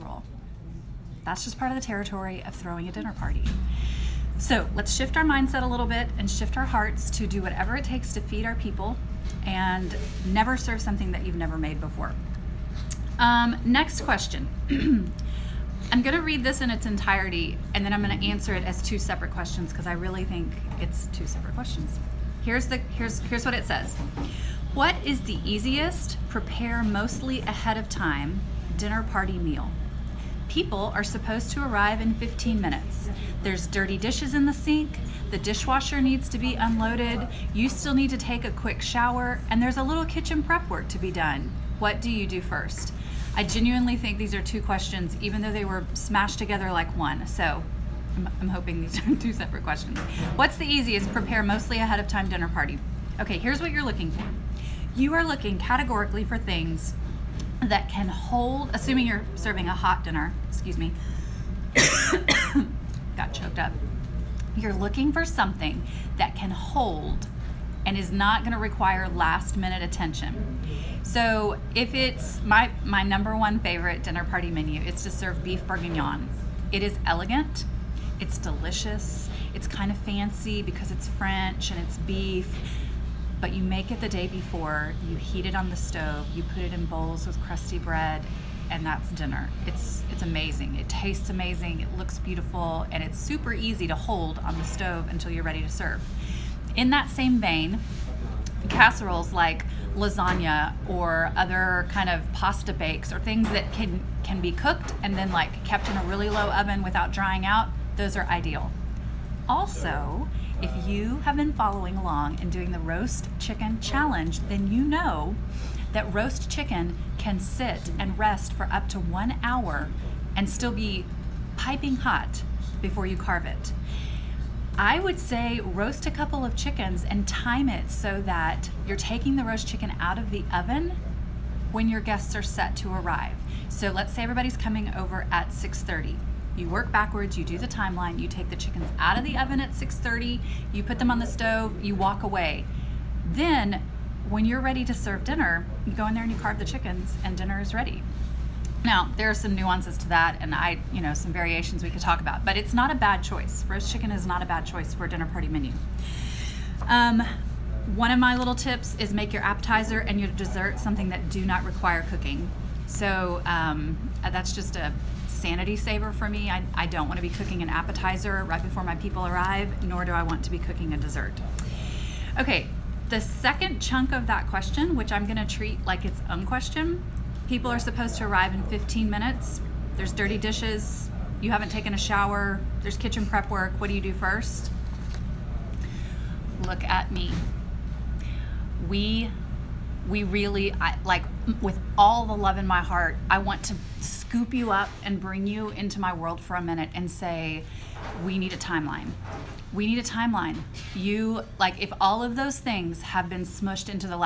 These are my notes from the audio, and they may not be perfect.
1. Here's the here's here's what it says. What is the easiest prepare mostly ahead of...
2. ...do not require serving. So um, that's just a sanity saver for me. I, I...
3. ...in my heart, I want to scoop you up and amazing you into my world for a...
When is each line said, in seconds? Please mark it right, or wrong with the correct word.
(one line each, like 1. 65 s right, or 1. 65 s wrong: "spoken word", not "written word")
1. 22 s right
2. 161 s wrong: "cooking", not "serving"
3. 192 s wrong: "bring", not "amazing".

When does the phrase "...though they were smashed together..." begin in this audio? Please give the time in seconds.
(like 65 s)
45 s.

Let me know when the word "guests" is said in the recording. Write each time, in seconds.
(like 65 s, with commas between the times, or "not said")
132 s.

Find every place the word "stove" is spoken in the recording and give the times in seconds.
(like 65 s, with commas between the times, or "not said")
85 s, 94 s, 141 s.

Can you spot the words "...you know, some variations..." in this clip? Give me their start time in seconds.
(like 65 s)
150 s.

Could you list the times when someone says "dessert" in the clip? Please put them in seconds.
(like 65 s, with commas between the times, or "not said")
160 s, 170 s.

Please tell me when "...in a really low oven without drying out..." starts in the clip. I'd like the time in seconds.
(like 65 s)
105 s.